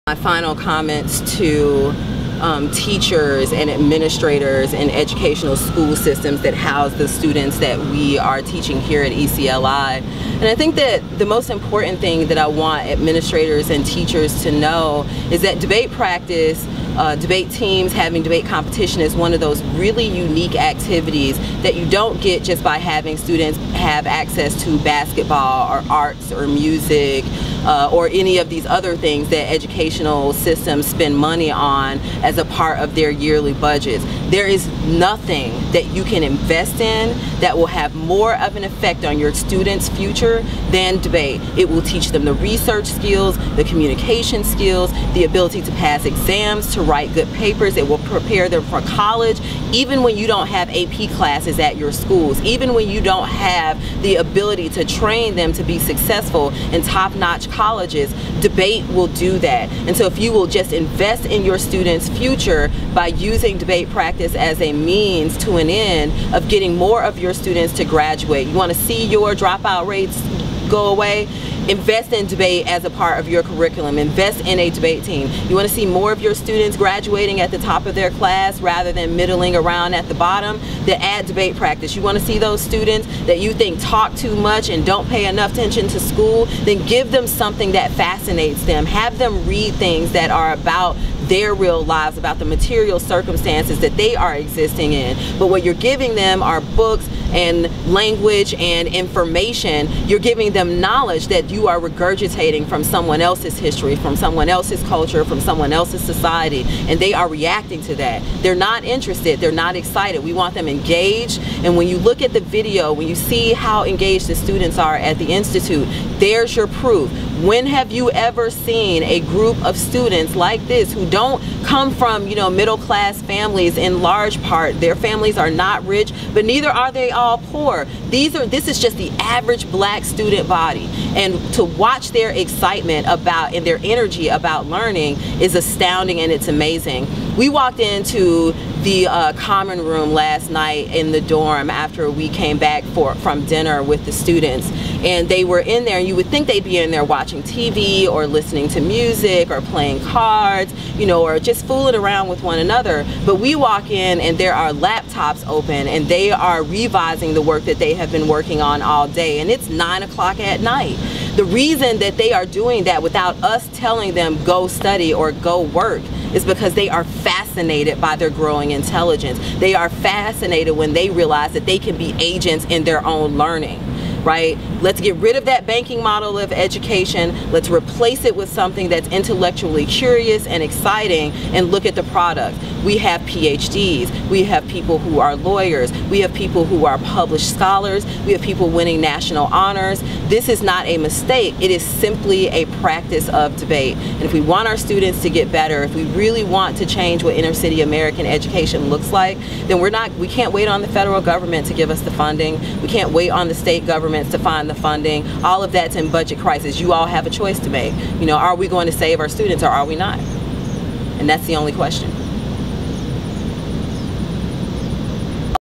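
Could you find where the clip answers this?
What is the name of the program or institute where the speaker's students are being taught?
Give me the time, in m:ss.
0:09.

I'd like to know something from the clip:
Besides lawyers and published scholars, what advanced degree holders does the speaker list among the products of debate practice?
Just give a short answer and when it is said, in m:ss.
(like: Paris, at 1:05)
PhDs, at 3:03.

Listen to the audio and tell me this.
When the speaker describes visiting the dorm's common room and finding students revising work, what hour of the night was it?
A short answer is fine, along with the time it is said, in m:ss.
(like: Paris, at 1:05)
9 o'clock, at 2:39.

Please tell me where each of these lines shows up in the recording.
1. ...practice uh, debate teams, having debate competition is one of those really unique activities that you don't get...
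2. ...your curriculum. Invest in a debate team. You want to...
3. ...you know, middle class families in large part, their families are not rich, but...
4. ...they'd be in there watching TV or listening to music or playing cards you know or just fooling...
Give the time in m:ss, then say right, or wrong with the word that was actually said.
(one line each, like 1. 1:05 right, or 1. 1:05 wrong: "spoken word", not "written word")
1. 0:15 right
2. 1:13 right
3. 2:02 right
4. 2:26 right.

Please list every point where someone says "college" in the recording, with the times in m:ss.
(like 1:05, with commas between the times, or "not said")
0:48, 0:57.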